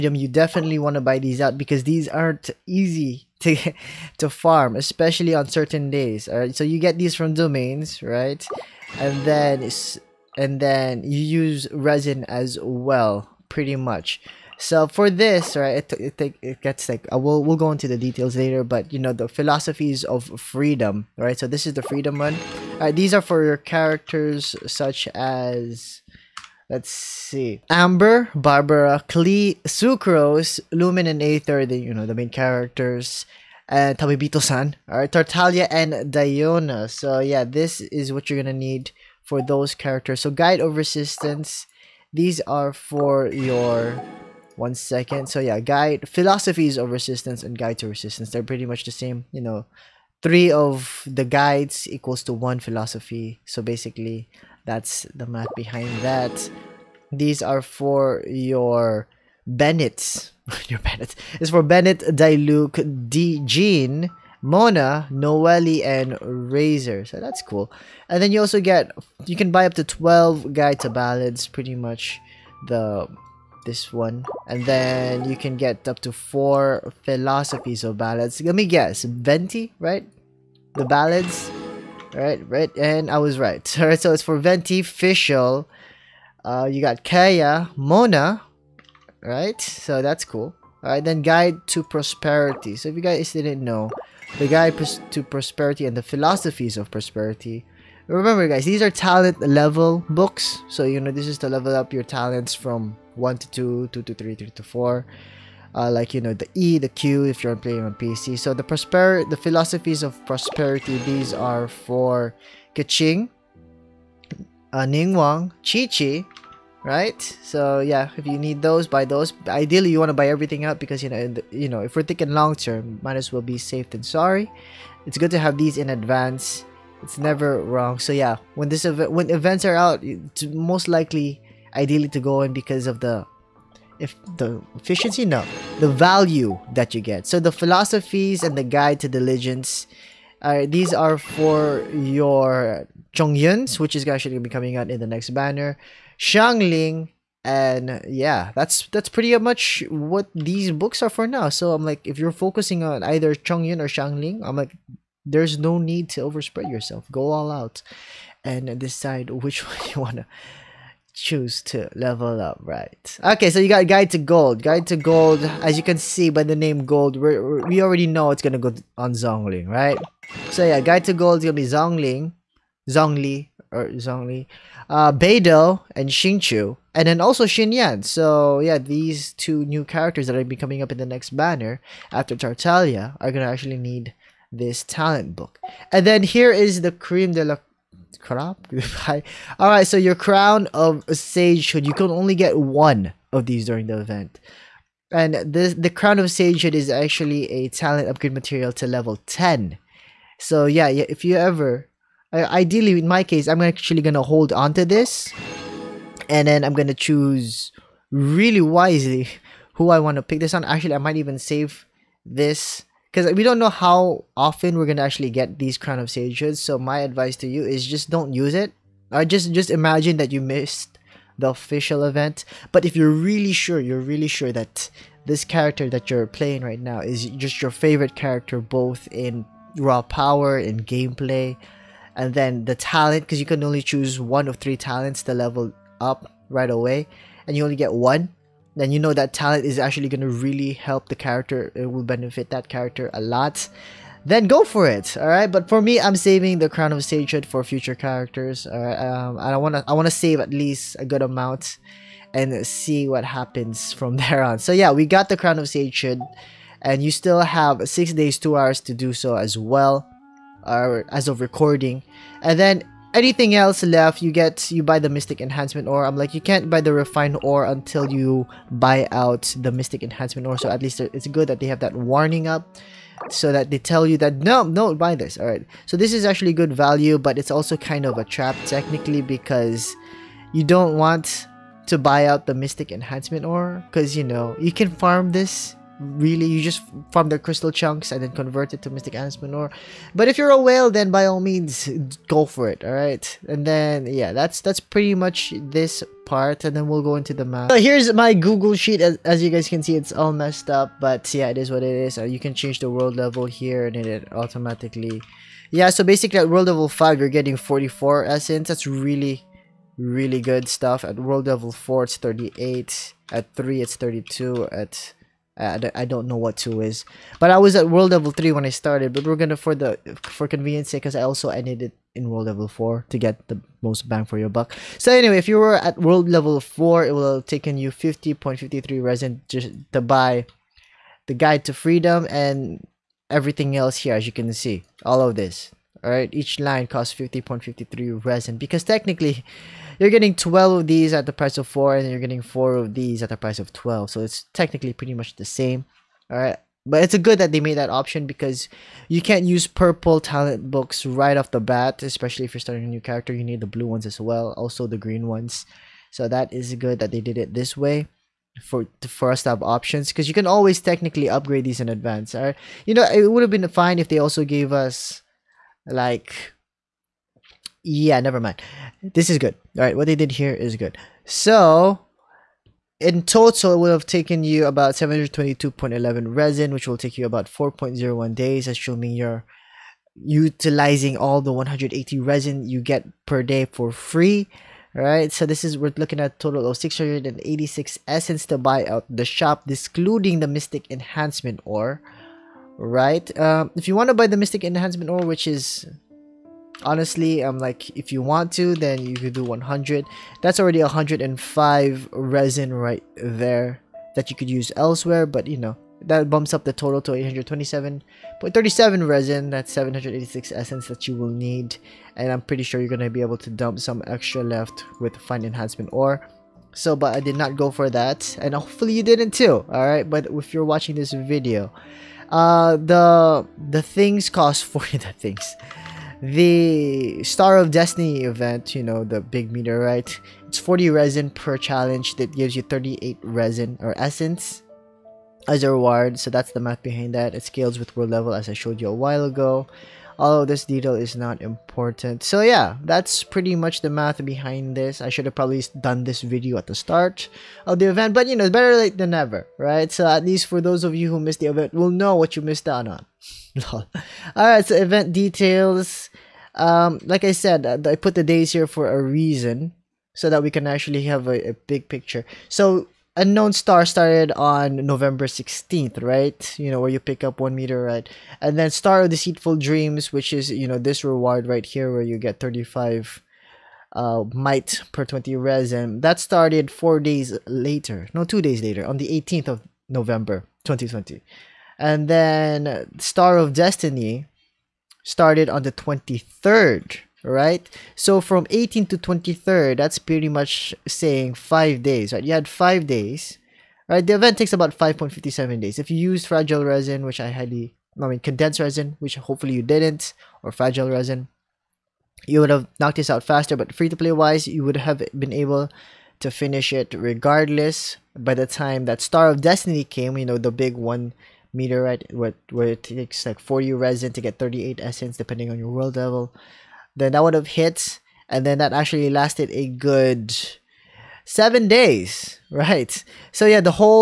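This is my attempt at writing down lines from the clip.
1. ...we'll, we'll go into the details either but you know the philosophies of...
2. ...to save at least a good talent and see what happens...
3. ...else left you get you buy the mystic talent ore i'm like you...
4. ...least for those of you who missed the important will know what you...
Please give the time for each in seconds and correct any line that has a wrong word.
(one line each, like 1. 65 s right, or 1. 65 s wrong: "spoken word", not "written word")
1. 17 s wrong: "later", not "either"
2. 250 s wrong: "amount", not "talent"
3. 263 s wrong: "enhancement", not "talent"
4. 450 s wrong: "event", not "important".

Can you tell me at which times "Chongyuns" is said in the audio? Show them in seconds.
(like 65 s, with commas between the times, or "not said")
143 s, 153 s.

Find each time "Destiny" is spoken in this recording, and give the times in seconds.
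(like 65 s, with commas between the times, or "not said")
427 s, 483 s, 509 s.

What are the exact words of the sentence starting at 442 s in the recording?
So yeah, that's pretty much the math behind this.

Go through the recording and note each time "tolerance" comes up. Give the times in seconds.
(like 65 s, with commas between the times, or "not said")
not said.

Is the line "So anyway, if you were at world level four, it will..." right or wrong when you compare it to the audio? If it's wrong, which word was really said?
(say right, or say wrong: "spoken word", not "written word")
right.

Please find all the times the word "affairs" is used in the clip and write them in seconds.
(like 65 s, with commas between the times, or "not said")
not said.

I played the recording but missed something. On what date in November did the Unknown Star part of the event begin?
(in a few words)
November 16.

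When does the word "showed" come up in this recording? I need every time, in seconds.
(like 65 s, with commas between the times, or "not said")
438 s.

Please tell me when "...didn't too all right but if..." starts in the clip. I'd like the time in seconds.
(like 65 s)
419 s.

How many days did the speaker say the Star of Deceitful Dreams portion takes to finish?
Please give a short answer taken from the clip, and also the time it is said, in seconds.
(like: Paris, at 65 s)
5.57, at 494 s.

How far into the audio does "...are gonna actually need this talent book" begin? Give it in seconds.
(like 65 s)
183 s.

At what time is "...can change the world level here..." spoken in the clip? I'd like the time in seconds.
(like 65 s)
302 s.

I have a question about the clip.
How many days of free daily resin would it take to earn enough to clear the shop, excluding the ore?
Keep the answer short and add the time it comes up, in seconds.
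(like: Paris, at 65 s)
4.01, at 377 s.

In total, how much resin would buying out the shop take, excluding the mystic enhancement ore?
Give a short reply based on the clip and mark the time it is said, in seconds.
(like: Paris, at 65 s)
722.11, at 374 s.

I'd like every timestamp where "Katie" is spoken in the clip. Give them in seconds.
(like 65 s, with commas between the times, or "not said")
not said.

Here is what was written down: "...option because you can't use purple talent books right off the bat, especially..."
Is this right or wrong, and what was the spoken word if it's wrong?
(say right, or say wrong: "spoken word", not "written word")
right.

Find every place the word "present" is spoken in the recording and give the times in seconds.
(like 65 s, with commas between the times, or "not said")
not said.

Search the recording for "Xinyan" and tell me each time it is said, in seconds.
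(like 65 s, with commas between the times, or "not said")
177 s.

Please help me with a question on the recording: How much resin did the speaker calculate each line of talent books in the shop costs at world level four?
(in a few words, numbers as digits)
50.53.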